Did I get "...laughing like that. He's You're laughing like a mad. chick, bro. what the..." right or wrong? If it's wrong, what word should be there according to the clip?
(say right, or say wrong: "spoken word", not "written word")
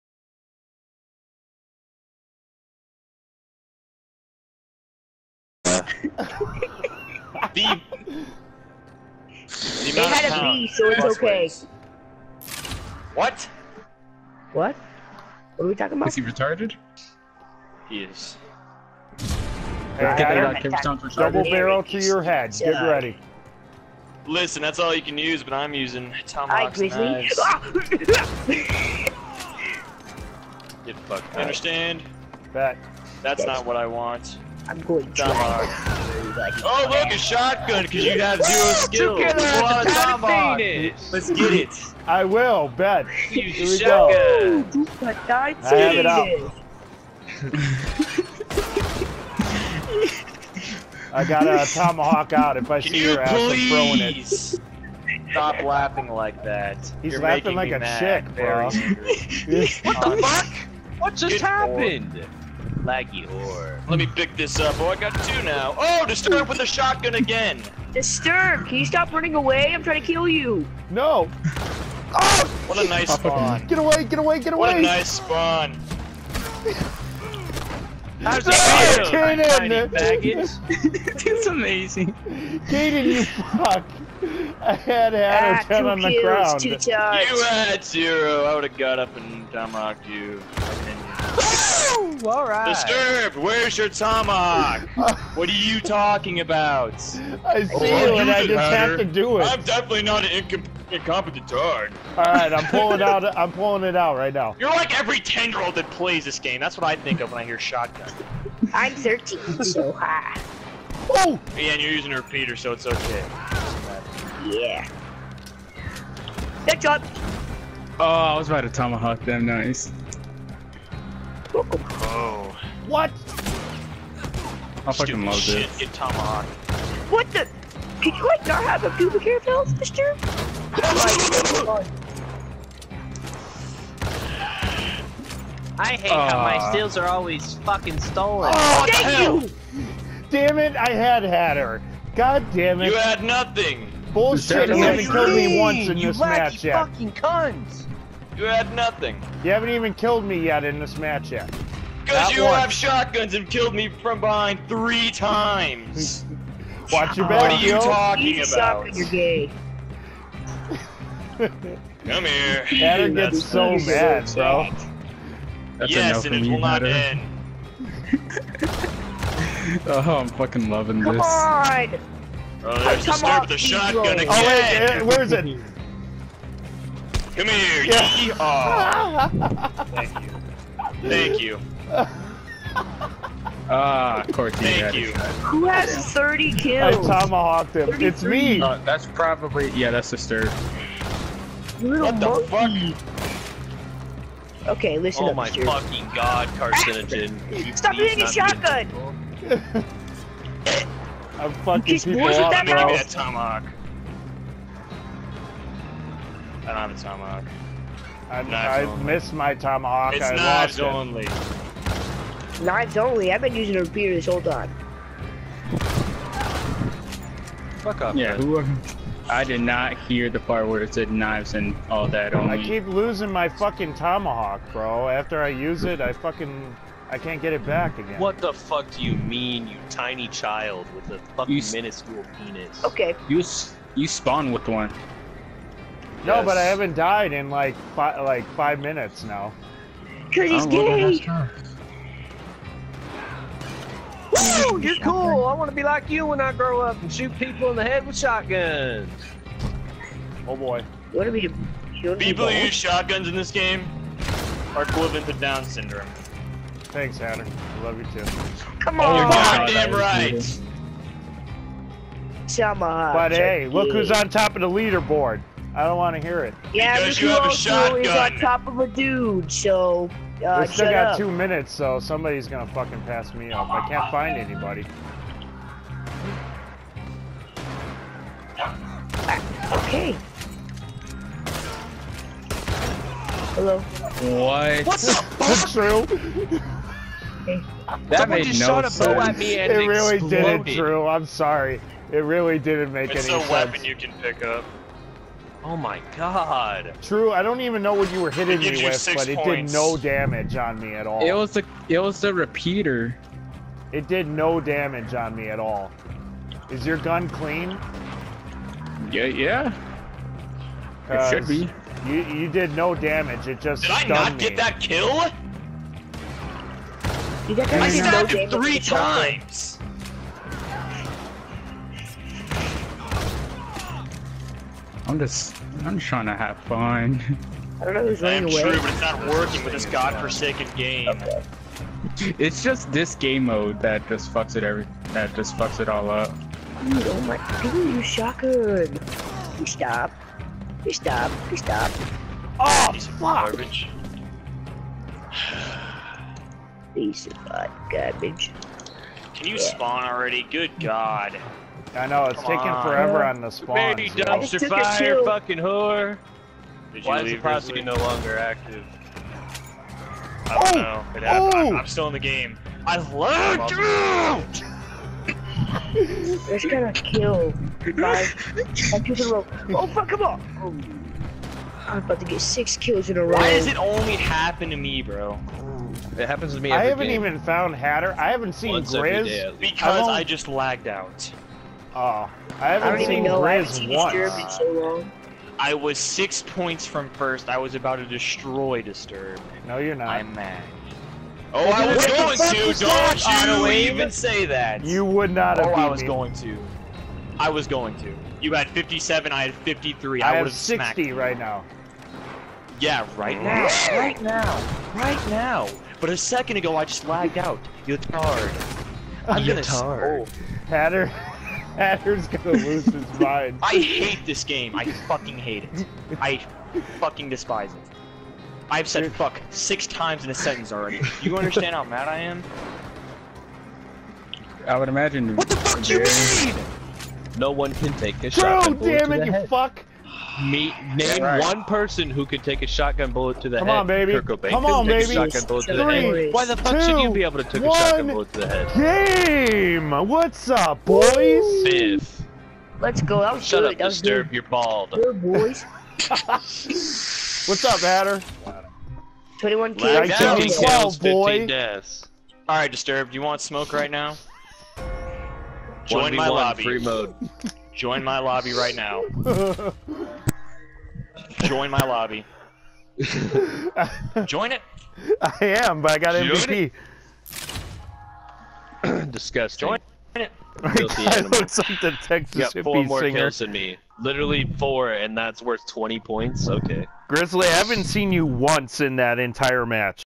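right.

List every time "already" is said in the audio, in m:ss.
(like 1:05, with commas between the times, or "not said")
5:50, 7:00.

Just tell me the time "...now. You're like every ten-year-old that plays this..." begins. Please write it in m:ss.
1:44.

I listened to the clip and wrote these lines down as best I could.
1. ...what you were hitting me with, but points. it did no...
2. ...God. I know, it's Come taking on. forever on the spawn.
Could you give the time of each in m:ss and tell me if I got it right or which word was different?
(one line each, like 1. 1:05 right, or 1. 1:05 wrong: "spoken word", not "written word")
1. 4:57 right
2. 5:50 right.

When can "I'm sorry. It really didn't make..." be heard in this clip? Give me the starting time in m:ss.
4:51.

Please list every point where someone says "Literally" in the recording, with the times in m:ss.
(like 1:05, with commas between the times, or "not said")
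7:54.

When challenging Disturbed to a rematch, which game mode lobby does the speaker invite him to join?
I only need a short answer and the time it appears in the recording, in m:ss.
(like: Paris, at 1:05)
Free mode, at 7:36.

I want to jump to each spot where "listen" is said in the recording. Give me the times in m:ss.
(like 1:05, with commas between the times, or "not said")
0:24, 3:14.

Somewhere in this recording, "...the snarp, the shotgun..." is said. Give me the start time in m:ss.
2:53.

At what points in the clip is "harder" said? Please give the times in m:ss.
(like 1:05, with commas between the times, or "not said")
not said.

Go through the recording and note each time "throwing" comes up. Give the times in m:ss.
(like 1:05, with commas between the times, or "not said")
0:53.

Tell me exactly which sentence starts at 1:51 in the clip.
Yeah, and you're using a repeater, so it's okay.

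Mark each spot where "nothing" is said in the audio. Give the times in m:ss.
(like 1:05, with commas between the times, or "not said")
2:23, 2:28.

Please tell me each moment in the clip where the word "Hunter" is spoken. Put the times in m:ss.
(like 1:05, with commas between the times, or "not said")
4:17.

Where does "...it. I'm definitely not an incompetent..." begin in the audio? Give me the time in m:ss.
1:39.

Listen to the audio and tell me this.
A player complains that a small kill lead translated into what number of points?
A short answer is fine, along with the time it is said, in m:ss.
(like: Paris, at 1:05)
20, at 7:55.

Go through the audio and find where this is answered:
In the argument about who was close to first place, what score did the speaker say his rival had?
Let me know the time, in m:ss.
6:38.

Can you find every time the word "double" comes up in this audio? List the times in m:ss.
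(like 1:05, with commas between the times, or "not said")
0:19.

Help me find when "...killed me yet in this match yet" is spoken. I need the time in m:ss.
2:29.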